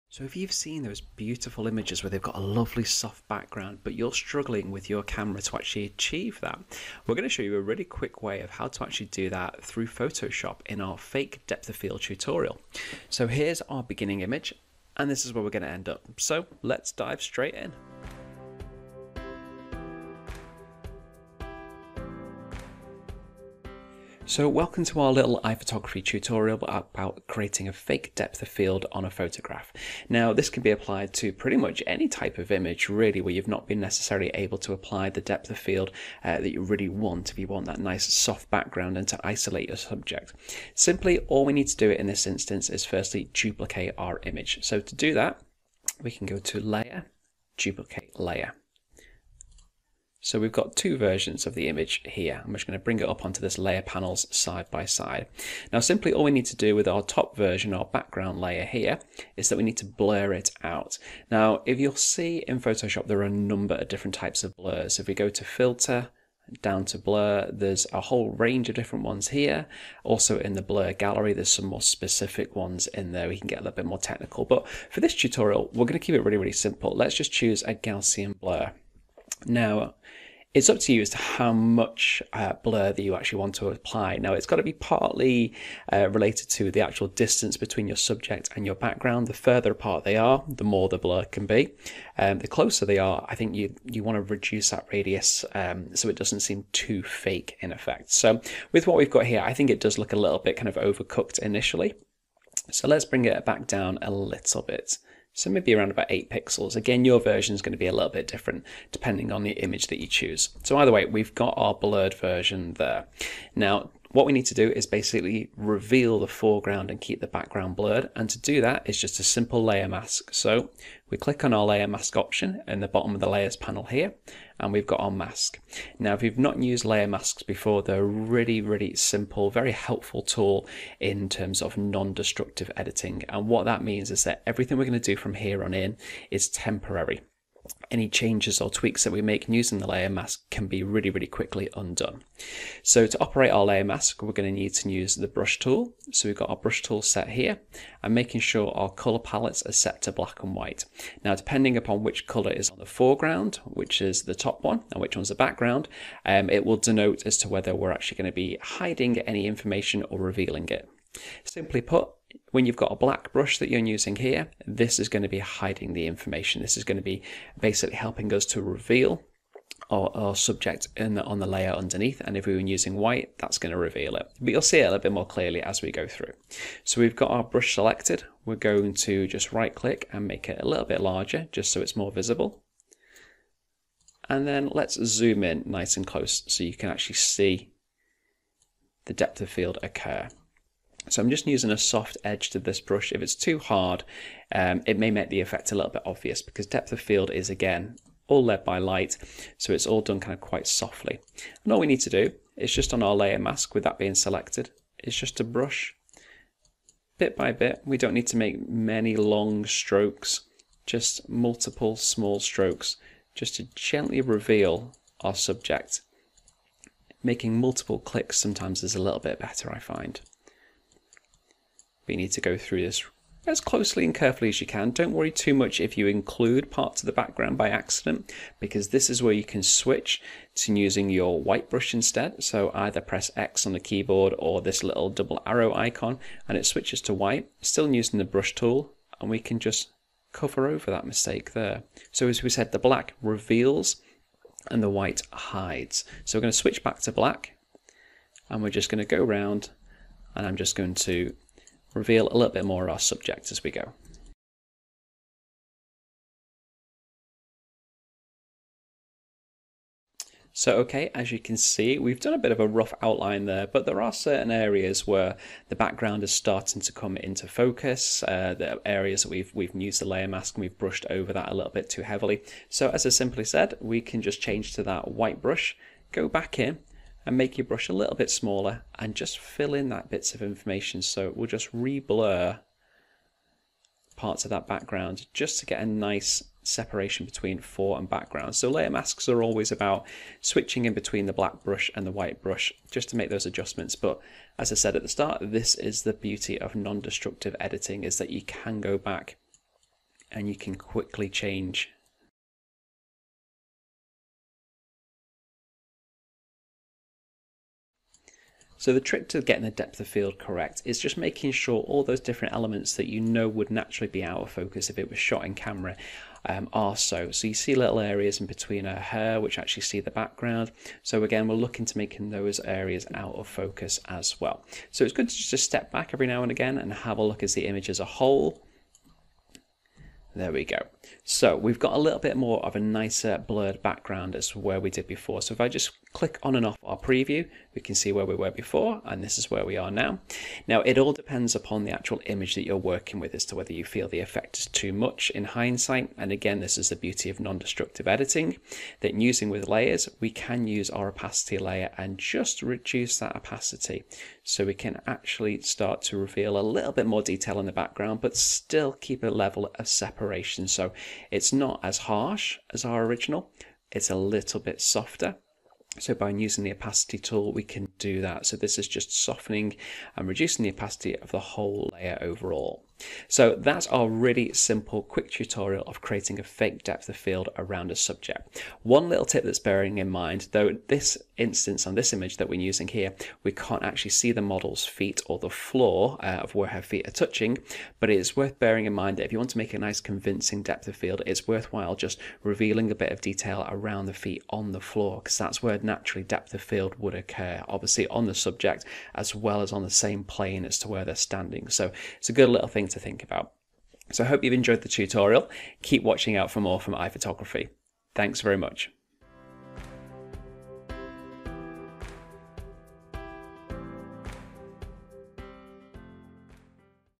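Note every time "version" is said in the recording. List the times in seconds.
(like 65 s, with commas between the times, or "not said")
50 s, 57 s, 107 s, 112 s.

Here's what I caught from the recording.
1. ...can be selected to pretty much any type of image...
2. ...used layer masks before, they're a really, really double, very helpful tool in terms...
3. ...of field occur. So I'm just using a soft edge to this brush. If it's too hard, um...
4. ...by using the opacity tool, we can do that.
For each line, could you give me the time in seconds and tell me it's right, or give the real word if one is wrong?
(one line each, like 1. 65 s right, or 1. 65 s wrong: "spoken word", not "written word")
1. 30 s wrong: "applied", not "selected"
2. 126 s wrong: "simple", not "double"
3. 189 s right
4. 366 s right.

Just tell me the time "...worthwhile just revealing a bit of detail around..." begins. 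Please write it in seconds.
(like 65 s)
391 s.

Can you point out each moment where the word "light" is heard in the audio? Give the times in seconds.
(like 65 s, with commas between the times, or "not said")
198 s.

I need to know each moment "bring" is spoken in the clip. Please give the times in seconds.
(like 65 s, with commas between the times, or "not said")
52 s, 103 s.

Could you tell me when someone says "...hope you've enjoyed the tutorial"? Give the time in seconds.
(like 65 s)
404 s.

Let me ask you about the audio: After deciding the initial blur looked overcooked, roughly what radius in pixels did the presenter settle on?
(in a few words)
8.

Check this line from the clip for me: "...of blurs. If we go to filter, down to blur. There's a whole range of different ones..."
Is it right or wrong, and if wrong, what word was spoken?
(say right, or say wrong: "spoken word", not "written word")
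right.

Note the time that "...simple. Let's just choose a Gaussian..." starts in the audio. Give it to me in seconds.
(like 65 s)
76 s.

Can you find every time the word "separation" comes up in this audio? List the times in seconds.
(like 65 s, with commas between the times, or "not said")
286 s, 359 s.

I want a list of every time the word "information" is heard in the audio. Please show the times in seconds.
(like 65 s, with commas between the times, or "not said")
159 s, 166 s, 280 s.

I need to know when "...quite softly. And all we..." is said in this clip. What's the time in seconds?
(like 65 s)
200 s.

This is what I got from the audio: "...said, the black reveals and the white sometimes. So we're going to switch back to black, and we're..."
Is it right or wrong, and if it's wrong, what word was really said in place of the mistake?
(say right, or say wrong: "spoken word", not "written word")
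wrong: "hides", not "sometimes".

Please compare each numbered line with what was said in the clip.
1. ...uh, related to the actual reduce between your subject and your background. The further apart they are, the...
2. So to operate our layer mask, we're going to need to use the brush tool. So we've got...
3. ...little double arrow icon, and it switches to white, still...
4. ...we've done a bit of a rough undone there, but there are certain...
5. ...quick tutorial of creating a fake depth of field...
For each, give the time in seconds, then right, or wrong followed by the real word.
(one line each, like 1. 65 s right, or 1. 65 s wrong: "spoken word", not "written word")
1. 85 s wrong: "distance", not "reduce"
2. 142 s right
3. 234 s right
4. 261 s wrong: "outline", not "undone"
5. 375 s right.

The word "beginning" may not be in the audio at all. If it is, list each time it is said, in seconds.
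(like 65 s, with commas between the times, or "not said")
13 s.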